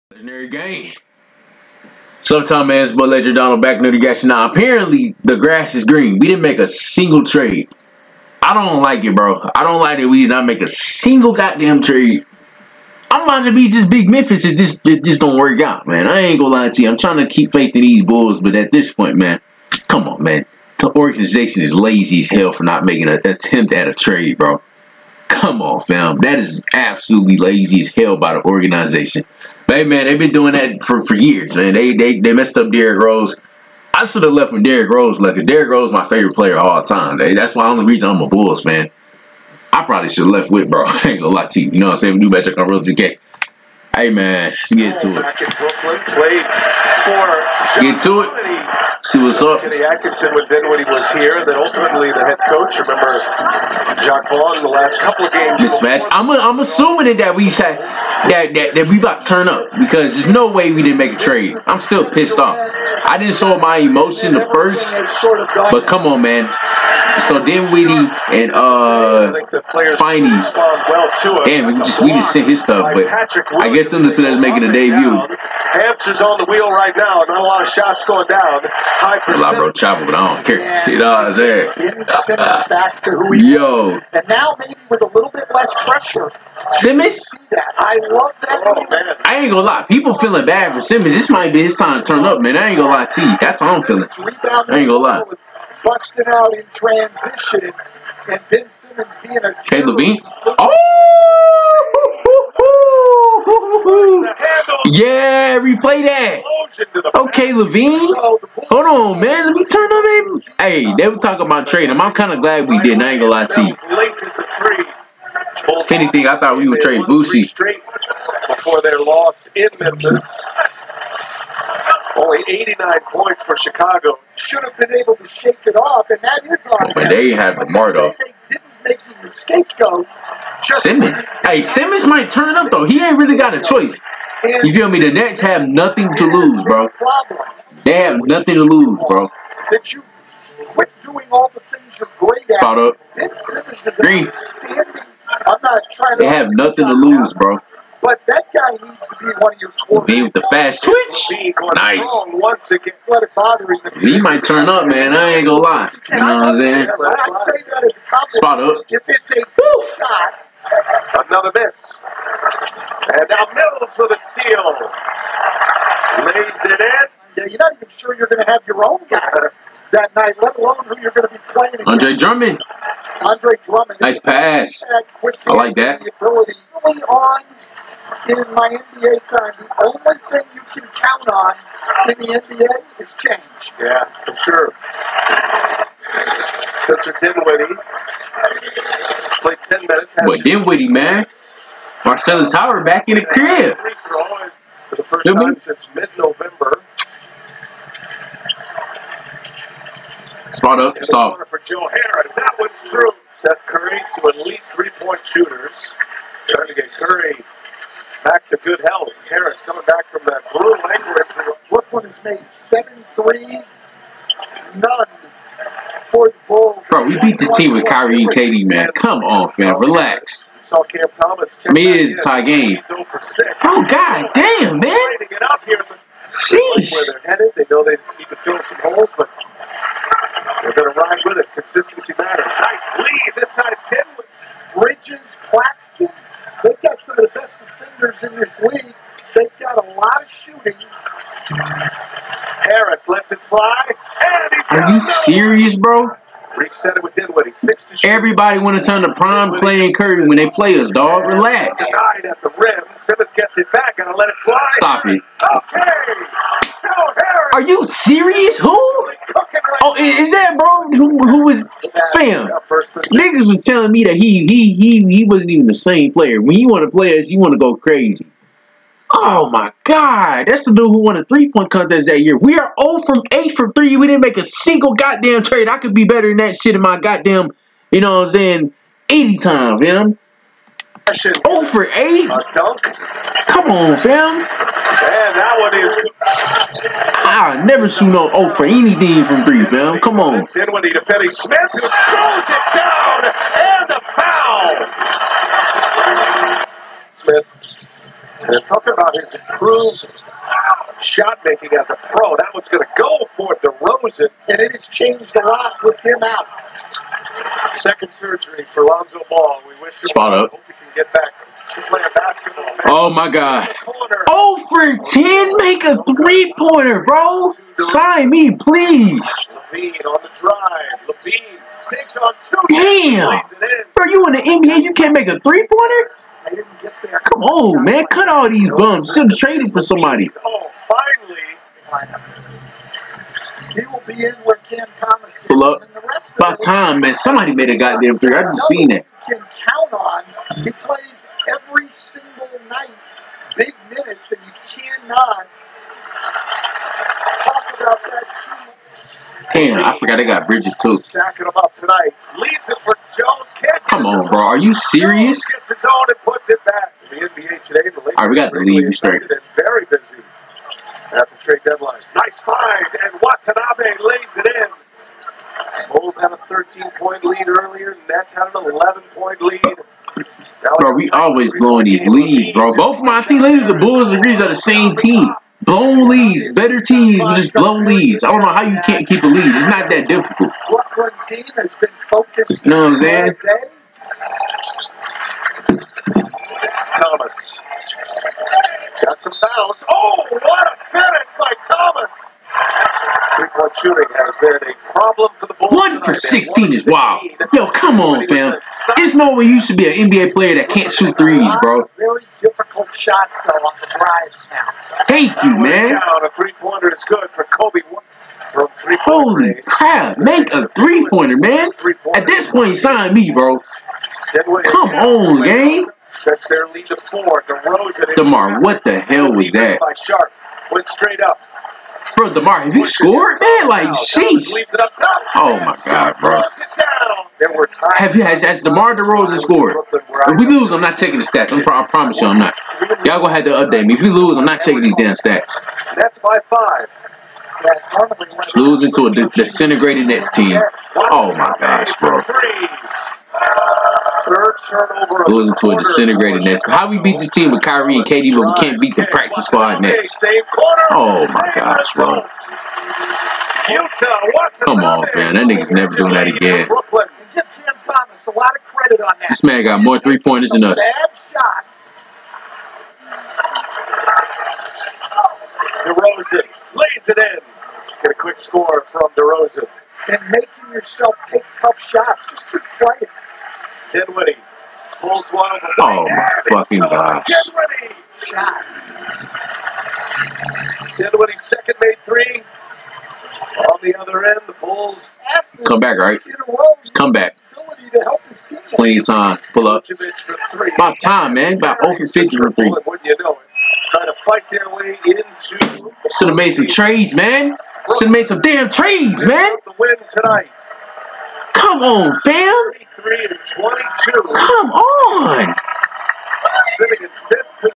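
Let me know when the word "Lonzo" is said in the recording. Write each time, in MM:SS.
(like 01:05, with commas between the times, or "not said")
05:08.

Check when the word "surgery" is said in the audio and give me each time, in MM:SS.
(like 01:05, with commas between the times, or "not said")
05:08.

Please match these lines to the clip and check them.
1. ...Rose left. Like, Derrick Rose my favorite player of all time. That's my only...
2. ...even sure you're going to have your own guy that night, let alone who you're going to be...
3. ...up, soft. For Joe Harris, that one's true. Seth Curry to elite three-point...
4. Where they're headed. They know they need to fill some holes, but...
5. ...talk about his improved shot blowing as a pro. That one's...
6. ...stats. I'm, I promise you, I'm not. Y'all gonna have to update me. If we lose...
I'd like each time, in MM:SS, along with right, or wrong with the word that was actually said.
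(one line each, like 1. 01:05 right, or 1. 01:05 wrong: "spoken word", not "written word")
1. 00:34 right
2. 02:47 right
3. 03:20 right
4. 03:46 right
5. 04:58 wrong: "making", not "blowing"
6. 07:11 right.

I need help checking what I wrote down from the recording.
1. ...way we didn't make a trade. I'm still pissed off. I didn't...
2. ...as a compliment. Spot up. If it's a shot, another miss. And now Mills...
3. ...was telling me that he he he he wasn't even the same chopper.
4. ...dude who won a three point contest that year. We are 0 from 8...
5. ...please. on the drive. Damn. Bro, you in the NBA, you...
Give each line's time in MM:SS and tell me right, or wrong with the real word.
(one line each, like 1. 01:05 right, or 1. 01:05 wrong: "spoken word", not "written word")
1. 01:00 right
2. 02:37 right
3. 04:23 wrong: "player", not "chopper"
4. 04:30 right
5. 05:18 right.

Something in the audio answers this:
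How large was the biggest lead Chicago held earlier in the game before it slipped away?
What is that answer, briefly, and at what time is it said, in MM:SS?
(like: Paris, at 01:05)
13 points, at 06:06.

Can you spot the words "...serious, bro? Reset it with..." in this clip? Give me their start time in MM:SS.
04:05.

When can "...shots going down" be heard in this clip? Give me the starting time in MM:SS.
01:17.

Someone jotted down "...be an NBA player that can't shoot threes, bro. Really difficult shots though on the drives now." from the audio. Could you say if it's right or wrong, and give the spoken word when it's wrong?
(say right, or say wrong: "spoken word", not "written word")
right.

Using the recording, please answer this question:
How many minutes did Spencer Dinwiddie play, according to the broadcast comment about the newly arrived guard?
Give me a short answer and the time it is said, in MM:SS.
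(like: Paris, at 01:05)
10, at 03:09.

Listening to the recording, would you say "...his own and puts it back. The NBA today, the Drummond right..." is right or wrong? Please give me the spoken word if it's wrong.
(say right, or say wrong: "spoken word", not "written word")
wrong: "All", not "Drummond".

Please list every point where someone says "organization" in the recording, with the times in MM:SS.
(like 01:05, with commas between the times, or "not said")
00:20, 00:28.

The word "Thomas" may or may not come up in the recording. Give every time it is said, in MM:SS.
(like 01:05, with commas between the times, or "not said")
03:41, 05:34, 06:27, 06:31.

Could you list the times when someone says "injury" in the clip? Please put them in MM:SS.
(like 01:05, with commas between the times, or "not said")
03:31.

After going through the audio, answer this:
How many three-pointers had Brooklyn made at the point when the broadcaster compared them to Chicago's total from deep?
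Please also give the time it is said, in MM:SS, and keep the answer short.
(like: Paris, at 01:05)
7, at 03:32.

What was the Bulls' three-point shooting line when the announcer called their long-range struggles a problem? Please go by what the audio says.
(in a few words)
1 for 16.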